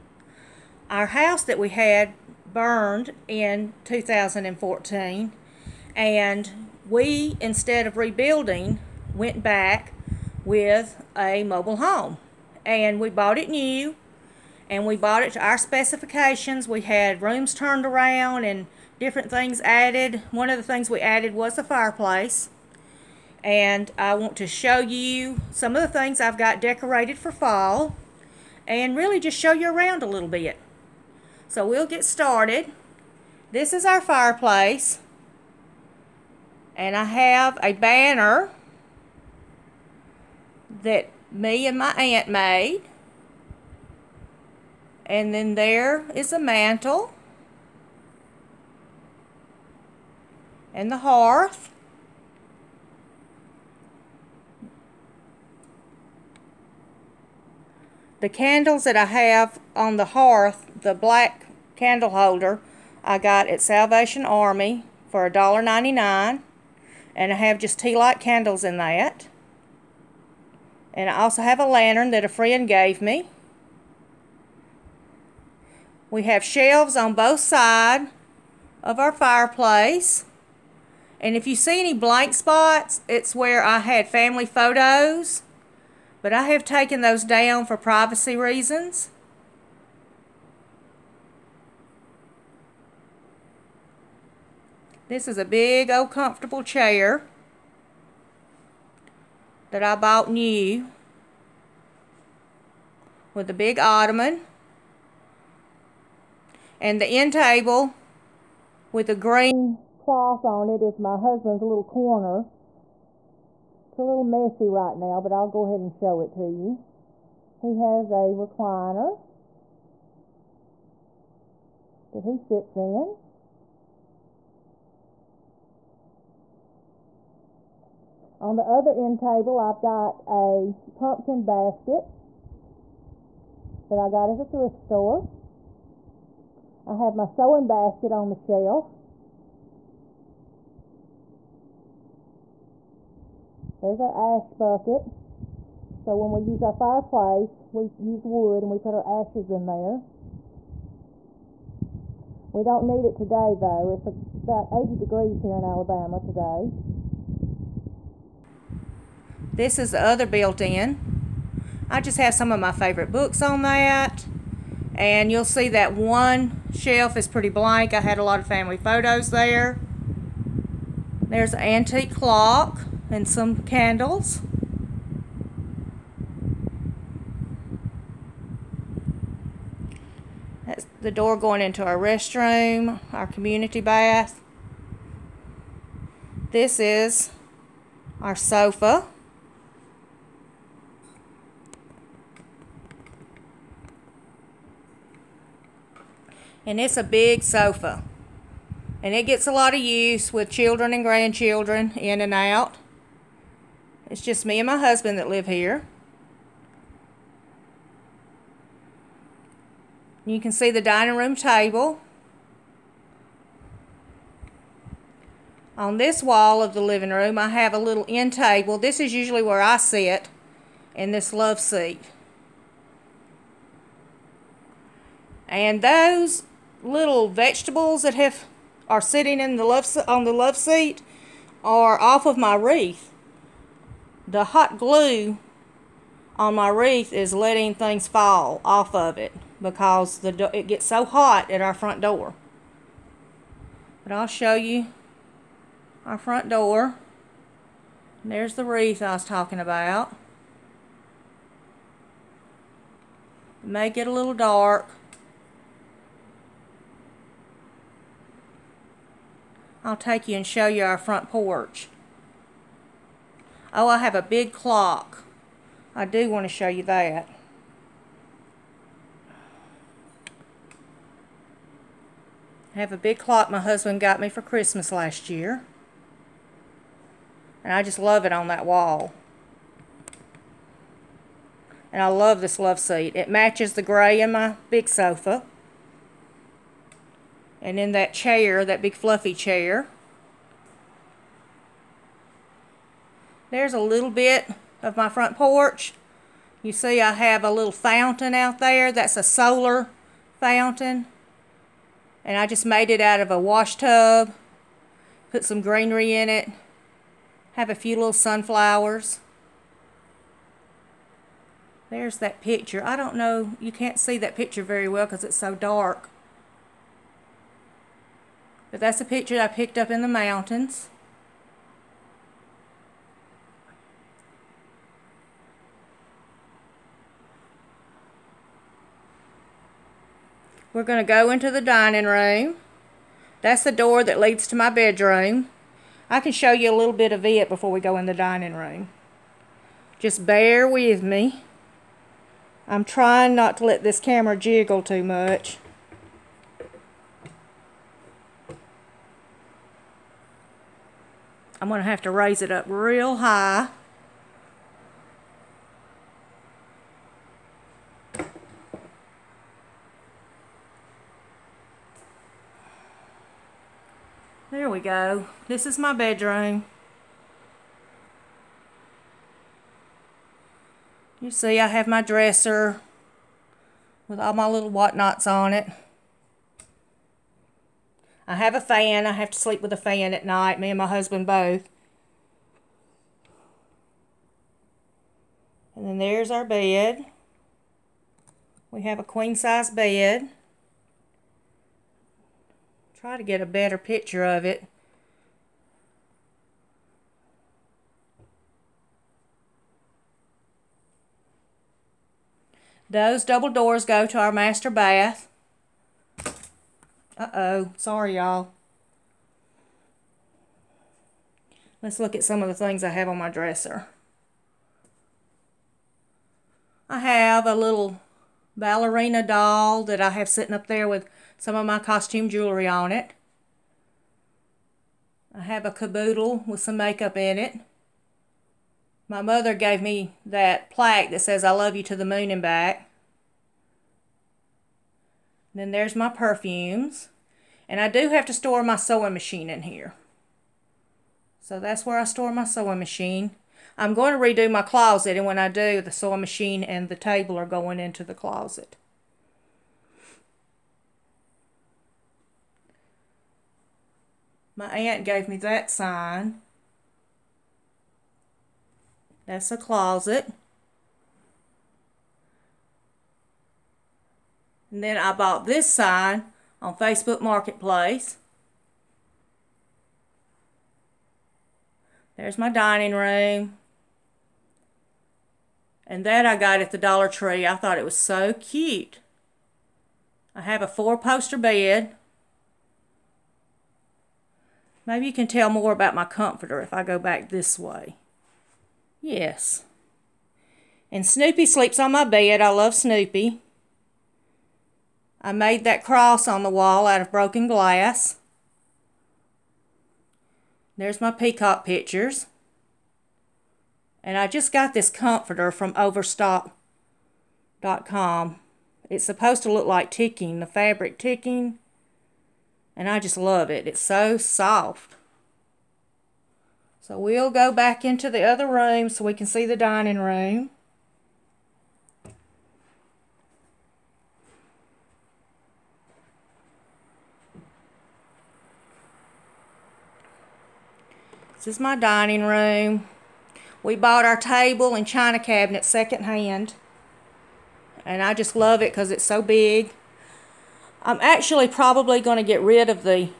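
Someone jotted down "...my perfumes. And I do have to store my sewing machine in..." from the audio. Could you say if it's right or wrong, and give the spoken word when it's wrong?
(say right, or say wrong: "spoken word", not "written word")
right.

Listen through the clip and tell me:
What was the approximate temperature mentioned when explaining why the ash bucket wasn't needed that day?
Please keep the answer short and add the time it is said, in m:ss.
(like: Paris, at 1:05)
80 degrees, at 2:34.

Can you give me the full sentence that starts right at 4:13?
It may get a little dark.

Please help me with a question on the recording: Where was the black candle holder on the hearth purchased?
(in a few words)
Salvation Army.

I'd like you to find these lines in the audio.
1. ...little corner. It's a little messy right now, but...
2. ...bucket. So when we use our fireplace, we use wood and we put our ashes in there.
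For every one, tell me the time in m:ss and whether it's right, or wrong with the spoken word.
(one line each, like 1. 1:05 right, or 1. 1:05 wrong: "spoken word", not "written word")
1. 1:51 right
2. 2:24 right.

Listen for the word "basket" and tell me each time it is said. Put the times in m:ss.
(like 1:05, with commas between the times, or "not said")
2:11, 2:17.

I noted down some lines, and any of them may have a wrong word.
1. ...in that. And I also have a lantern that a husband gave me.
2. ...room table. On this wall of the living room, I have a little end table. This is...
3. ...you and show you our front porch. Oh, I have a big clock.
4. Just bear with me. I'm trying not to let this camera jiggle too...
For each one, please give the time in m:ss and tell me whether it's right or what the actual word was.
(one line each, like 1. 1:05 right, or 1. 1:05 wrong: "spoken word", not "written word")
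1. 1:08 wrong: "friend", not "husband"
2. 3:31 right
3. 4:20 right
4. 5:39 right.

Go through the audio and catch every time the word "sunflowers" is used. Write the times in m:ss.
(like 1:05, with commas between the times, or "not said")
5:08.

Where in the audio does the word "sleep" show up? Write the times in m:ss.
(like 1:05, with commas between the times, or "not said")
6:19, 8:11.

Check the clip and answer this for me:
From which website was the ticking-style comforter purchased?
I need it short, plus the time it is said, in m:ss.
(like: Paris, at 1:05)
overstock.com, at 8:25.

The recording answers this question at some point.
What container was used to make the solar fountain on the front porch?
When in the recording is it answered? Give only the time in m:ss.
5:03.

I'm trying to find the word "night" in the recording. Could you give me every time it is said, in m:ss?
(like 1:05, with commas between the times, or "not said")
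6:20.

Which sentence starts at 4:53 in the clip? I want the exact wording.
There's a little bit of my front porch.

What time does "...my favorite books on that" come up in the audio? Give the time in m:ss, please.
2:42.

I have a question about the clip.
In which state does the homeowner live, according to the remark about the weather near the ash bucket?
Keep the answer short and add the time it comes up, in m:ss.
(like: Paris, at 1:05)
Alabama, at 2:35.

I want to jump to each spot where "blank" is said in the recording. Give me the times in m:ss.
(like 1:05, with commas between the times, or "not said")
1:21, 2:47.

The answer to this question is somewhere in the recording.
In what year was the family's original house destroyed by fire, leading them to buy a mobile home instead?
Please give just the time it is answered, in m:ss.
0:03.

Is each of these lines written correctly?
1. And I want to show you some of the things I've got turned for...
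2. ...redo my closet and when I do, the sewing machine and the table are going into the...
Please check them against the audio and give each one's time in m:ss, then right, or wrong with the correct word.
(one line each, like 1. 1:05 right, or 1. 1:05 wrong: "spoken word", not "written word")
1. 0:23 wrong: "decorated", not "turned"
2. 7:24 right.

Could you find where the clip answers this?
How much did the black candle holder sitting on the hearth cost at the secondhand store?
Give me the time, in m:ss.
1:05.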